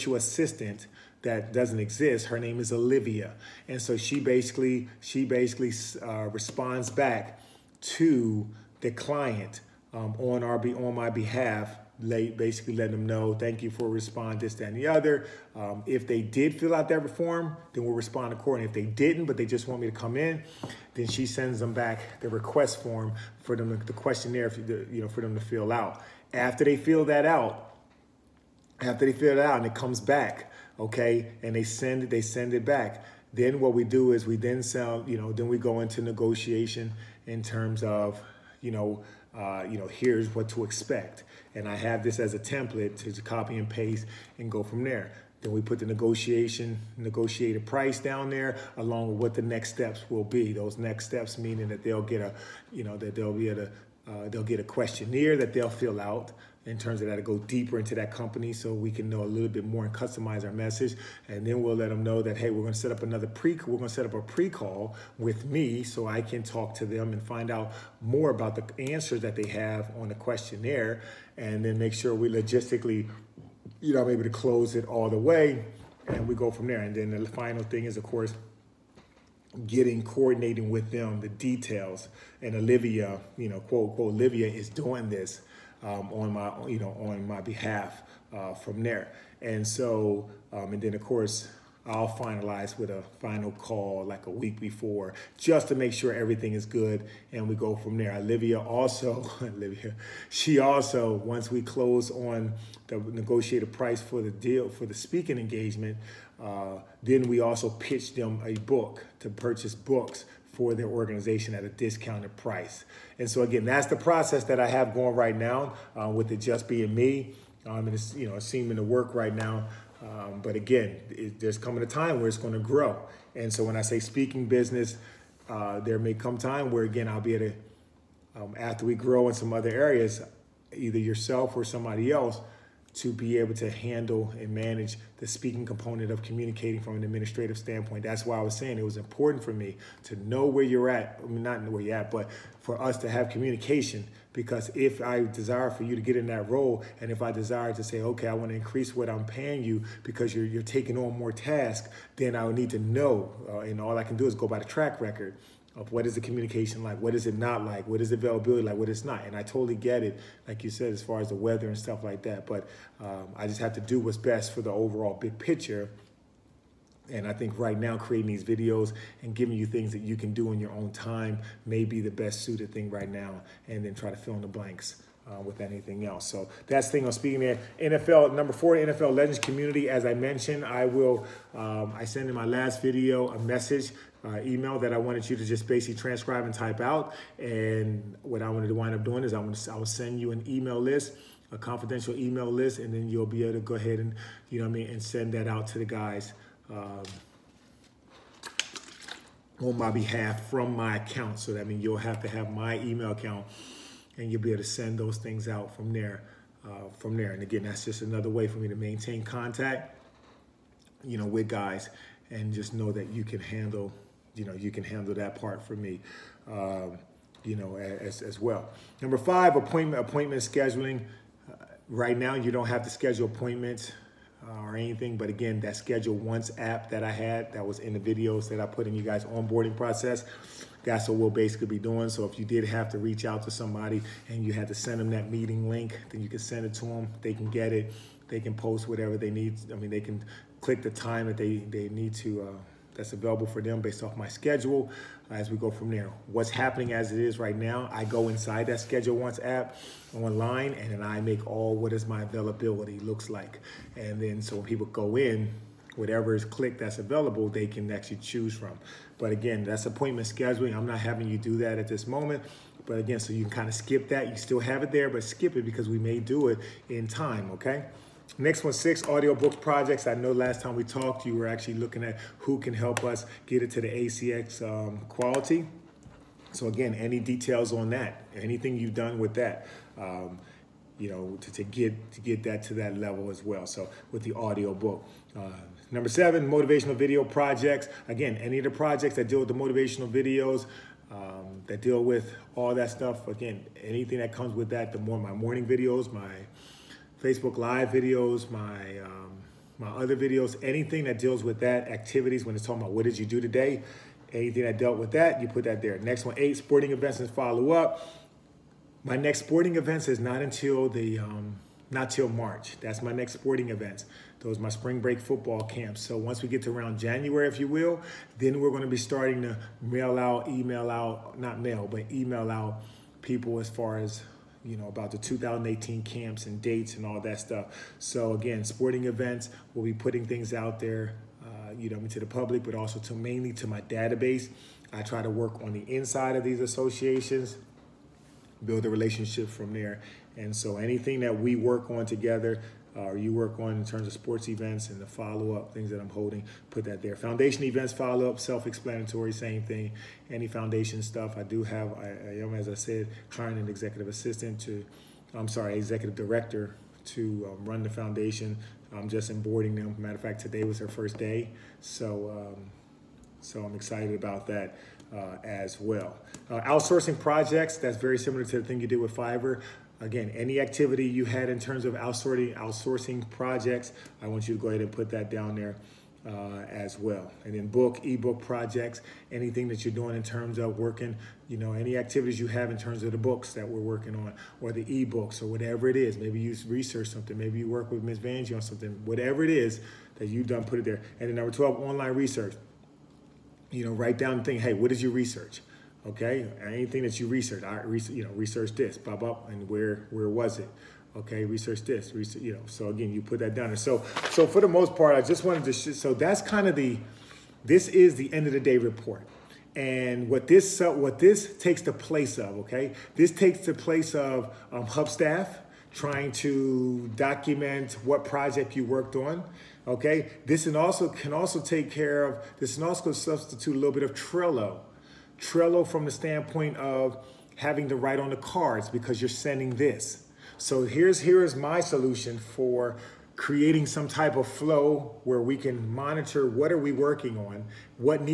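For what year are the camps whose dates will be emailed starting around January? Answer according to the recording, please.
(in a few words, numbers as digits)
2018.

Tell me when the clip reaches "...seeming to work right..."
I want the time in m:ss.
1:58.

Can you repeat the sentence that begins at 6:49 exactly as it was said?
And what this, so what this takes the place of, okay?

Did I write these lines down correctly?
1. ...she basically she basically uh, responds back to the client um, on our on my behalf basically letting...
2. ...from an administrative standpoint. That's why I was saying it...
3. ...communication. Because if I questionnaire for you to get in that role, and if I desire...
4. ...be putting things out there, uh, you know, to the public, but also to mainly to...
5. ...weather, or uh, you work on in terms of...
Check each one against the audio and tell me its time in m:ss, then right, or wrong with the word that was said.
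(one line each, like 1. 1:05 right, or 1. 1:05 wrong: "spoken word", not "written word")
1. 0:03 right
2. 2:16 right
3. 2:23 wrong: "desire", not "questionnaire"
4. 5:29 right
5. 5:42 wrong: "together", not "weather".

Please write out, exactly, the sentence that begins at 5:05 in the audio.
Next one, eight, sporting events and follow up.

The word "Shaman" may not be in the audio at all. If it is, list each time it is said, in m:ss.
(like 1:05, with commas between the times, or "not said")
not said.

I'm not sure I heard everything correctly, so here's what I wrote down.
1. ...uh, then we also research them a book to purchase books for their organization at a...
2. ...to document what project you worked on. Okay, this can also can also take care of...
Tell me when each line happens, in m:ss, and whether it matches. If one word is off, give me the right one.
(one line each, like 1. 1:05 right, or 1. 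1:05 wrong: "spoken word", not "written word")
1. 1:46 wrong: "pitch", not "research"
2. 6:56 right.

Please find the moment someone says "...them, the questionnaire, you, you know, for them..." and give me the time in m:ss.
0:23.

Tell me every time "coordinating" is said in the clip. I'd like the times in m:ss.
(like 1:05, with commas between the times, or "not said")
1:20.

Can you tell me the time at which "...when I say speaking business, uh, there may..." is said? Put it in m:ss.
2:03.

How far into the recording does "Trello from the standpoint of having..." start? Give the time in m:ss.
7:05.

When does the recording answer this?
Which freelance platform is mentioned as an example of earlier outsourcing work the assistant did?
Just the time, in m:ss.
6:09.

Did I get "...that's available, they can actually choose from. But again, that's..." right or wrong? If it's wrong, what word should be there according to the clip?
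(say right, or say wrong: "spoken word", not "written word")
right.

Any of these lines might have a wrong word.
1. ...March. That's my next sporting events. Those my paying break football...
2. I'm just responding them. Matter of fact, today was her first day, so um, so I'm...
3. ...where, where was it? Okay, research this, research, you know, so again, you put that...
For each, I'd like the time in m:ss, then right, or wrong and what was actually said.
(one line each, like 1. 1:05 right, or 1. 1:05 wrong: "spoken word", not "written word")
1. 5:12 wrong: "spring", not "paying"
2. 5:58 wrong: "onboarding", not "responding"
3. 6:39 right.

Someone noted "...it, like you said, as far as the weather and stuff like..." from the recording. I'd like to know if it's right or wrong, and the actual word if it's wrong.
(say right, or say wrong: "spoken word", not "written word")
right.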